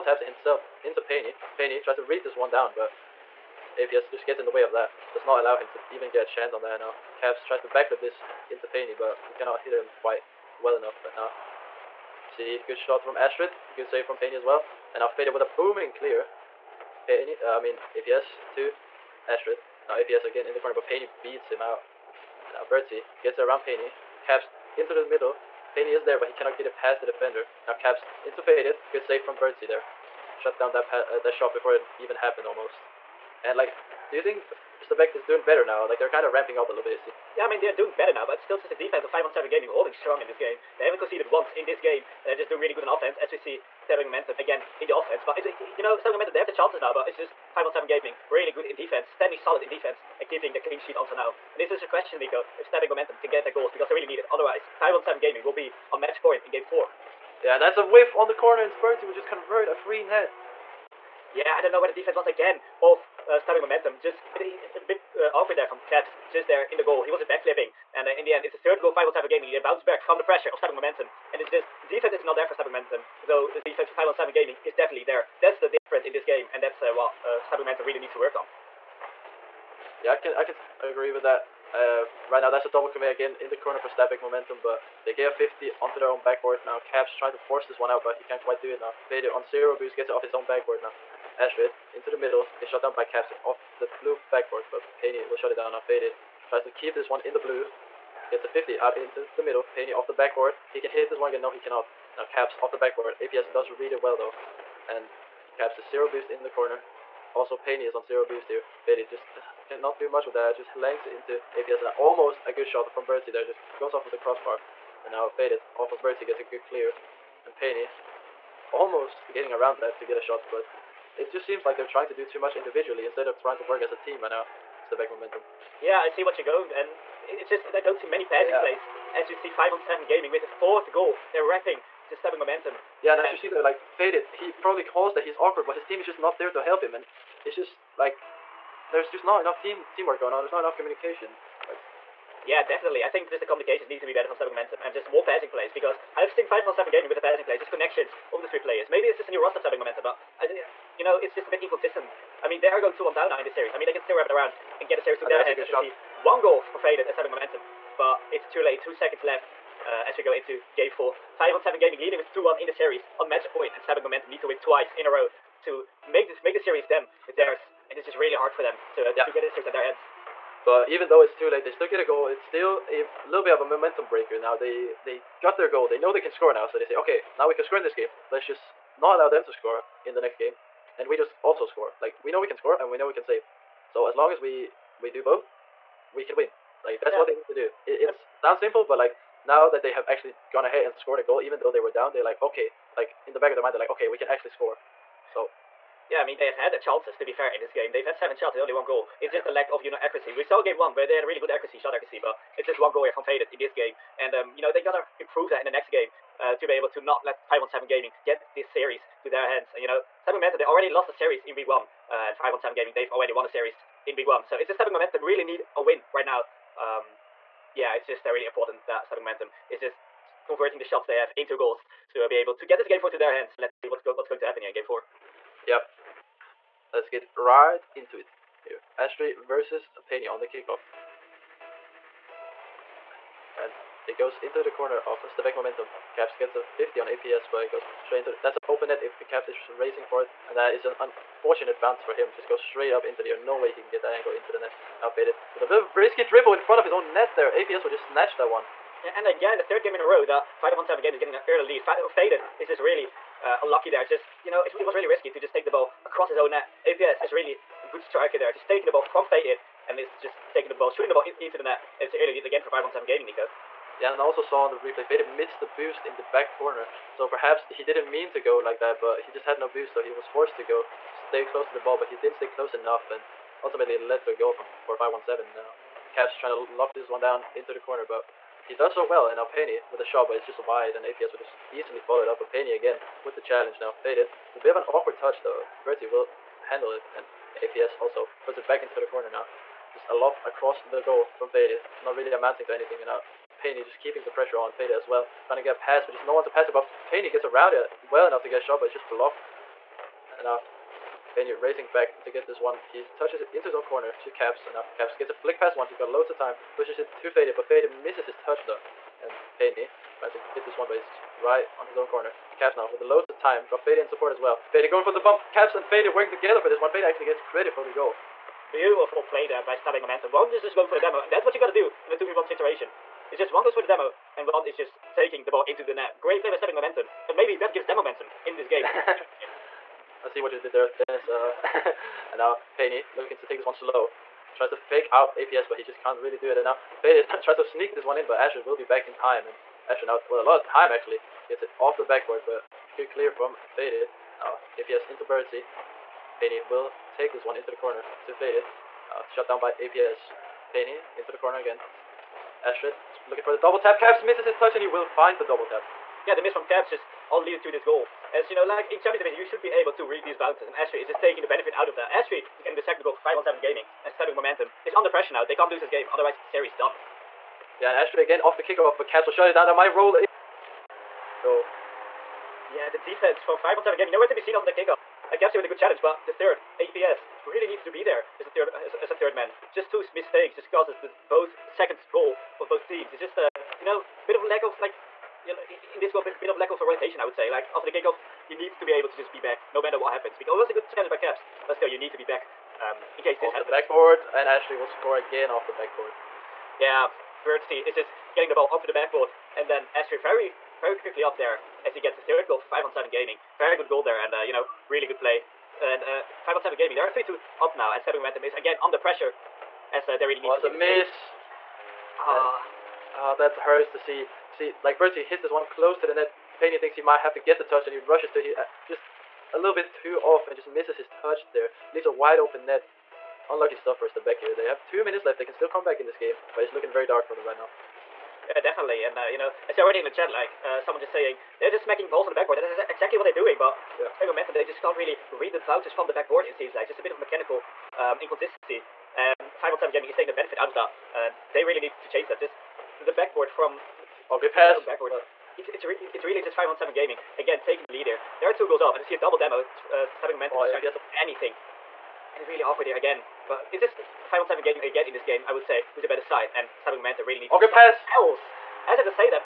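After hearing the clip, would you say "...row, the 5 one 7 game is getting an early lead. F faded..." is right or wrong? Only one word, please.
right.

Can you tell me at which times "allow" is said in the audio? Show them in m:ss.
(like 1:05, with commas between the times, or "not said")
0:05, 2:59.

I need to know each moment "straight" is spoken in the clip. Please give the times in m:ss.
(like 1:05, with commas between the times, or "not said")
3:58, 4:02.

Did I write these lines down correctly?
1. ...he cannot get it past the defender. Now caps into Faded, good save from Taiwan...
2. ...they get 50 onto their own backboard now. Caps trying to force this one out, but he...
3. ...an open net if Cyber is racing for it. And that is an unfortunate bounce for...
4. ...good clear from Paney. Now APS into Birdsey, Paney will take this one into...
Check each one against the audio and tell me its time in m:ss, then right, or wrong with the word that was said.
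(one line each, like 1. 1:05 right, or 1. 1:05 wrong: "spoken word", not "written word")
1. 0:26 wrong: "Bertie", not "Taiwan"
2. 1:25 right
3. 3:58 wrong: "Caps", not "Cyber"
4. 5:42 wrong: "Faded", not "Paney".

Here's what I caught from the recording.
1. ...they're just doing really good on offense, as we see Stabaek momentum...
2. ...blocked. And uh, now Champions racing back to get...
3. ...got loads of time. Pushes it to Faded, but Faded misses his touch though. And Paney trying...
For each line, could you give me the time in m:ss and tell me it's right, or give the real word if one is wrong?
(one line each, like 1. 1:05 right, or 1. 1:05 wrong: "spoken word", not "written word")
1. 0:42 right
2. 4:59 wrong: "Paney", not "Champions"
3. 5:05 right.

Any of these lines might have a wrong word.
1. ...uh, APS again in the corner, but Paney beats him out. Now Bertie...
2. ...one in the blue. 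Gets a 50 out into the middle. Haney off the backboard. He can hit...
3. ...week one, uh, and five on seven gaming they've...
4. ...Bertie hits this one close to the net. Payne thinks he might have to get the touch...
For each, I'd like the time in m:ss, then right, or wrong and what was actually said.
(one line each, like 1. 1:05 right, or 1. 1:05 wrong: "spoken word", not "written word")
1. 0:19 right
2. 1:37 right
3. 3:31 right
4. 6:54 right.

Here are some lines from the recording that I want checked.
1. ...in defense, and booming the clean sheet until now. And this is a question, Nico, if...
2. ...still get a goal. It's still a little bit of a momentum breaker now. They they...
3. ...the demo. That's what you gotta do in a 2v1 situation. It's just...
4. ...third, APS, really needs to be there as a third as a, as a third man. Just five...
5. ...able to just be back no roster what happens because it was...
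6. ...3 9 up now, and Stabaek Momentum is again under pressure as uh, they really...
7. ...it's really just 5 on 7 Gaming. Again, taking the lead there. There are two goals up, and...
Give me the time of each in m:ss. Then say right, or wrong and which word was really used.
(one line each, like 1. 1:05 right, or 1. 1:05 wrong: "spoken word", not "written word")
1. 0:49 wrong: "keeping", not "booming"
2. 2:51 right
3. 5:20 right
4. 6:16 wrong: "two", not "five"
5. 6:28 wrong: "matter", not "roster"
6. 6:47 wrong: "2", not "9"
7. 7:26 right.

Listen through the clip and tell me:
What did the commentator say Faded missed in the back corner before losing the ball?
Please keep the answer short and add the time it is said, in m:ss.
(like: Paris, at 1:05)
The boost, at 4:25.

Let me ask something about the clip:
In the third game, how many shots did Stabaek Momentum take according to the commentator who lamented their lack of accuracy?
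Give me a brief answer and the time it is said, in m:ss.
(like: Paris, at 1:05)
7, at 3:18.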